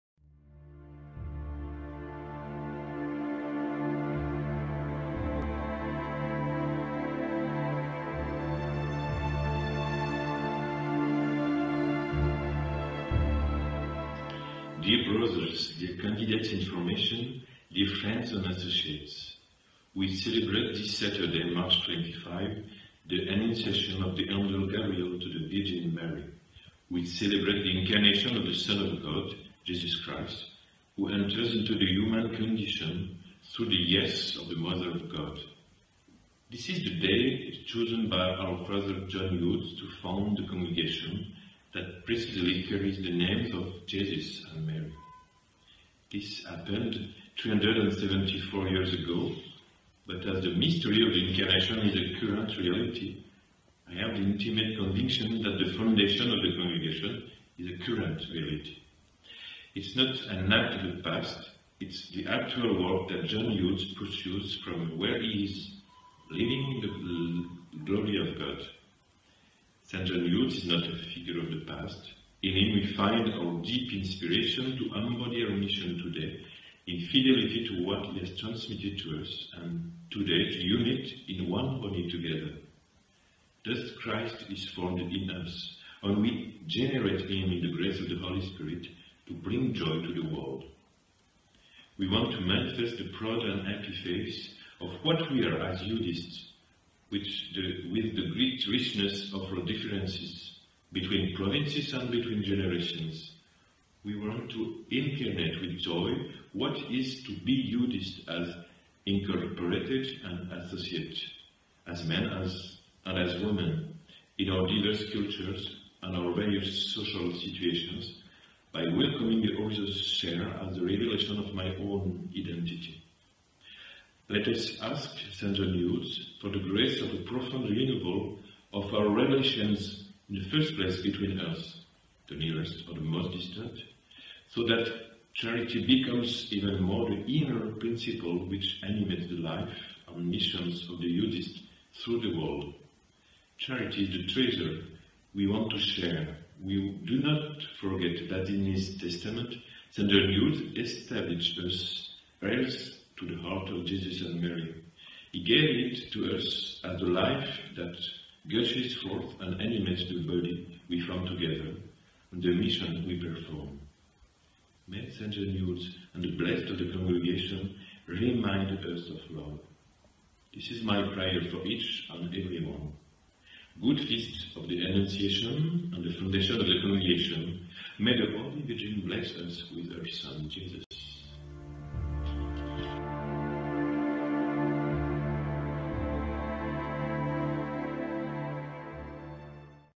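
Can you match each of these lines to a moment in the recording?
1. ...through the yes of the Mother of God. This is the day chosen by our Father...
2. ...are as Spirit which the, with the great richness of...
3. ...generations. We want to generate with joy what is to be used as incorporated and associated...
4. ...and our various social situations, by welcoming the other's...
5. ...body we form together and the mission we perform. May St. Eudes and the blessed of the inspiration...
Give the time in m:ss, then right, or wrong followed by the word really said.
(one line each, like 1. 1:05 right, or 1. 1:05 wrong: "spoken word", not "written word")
1. 0:33 right
2. 1:35 wrong: "Eudists", not "Spirit"
3. 1:42 wrong: "incarnate", not "generate"
4. 1:56 right
5. 2:40 wrong: "congregation", not "inspiration".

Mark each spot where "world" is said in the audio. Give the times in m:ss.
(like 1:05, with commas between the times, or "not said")
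1:30, 2:22.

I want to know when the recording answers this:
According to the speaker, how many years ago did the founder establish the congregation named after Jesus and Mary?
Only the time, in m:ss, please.
0:47.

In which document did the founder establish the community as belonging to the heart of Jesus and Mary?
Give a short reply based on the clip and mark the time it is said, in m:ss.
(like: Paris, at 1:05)
his testament, at 2:28.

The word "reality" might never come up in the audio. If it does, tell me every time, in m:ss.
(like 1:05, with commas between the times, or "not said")
0:52, 0:58.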